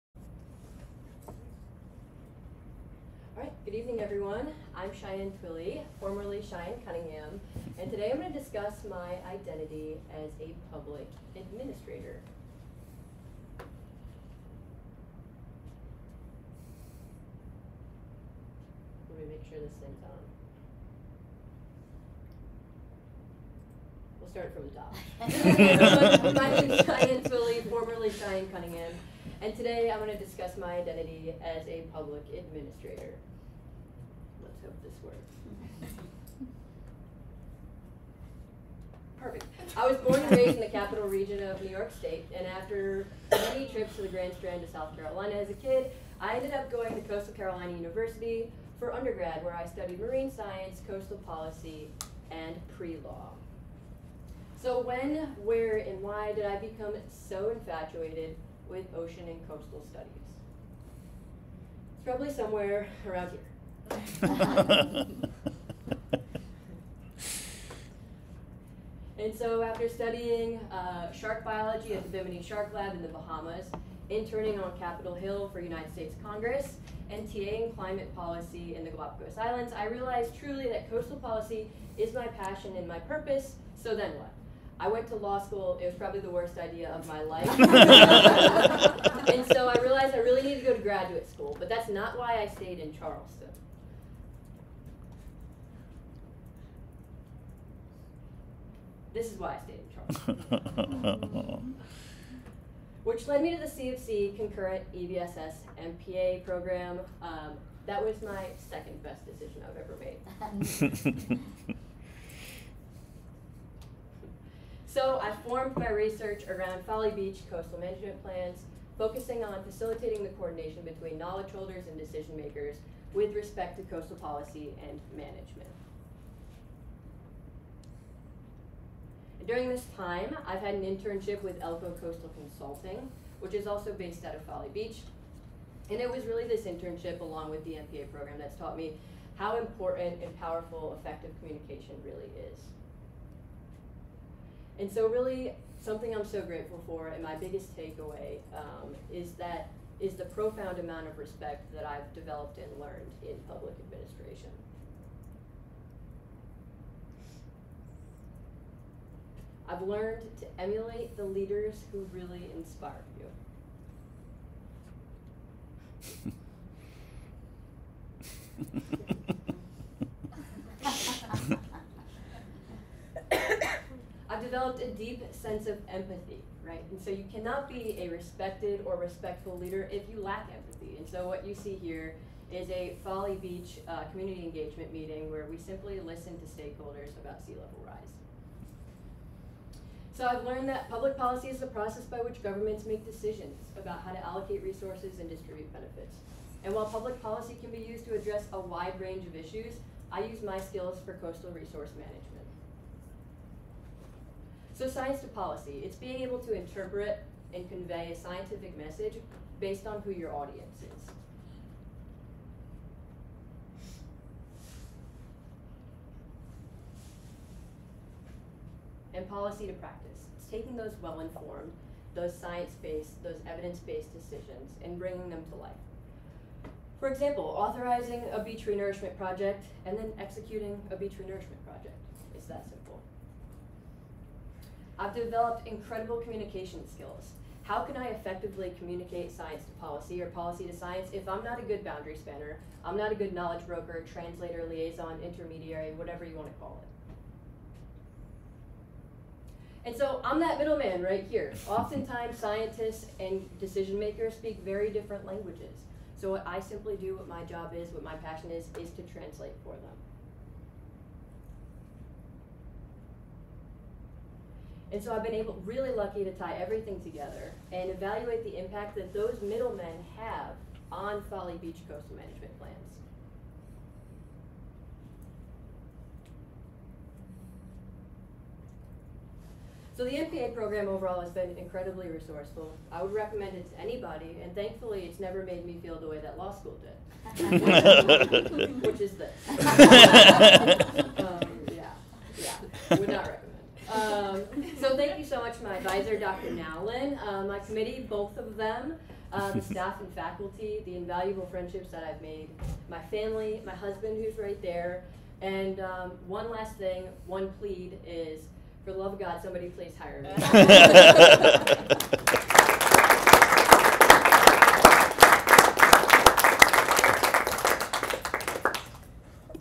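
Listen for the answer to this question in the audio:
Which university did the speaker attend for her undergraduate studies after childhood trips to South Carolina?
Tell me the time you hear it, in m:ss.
0:47.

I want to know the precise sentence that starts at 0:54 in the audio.
So when, where, and why did I become so infatuated with ocean and coastal studies?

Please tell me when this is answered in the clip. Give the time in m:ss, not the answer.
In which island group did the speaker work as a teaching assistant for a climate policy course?
1:18.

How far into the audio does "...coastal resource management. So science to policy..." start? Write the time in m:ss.
3:21.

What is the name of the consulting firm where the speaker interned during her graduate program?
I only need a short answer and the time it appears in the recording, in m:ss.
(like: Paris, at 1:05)
Elko Coastal Consulting, at 2:11.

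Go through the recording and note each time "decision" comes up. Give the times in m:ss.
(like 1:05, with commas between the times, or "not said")
1:49, 2:01, 3:13, 3:44, 4:13.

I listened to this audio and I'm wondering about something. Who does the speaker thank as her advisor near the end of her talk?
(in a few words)
Dr. Nowlin.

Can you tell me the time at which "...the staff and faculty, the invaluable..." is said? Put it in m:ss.
4:59.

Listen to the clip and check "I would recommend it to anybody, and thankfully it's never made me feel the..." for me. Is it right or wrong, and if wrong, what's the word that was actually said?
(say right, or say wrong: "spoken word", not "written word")
right.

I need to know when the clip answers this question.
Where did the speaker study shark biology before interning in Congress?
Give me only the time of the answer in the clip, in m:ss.
1:12.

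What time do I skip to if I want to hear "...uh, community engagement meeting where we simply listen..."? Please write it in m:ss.
3:03.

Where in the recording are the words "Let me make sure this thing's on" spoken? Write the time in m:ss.
0:19.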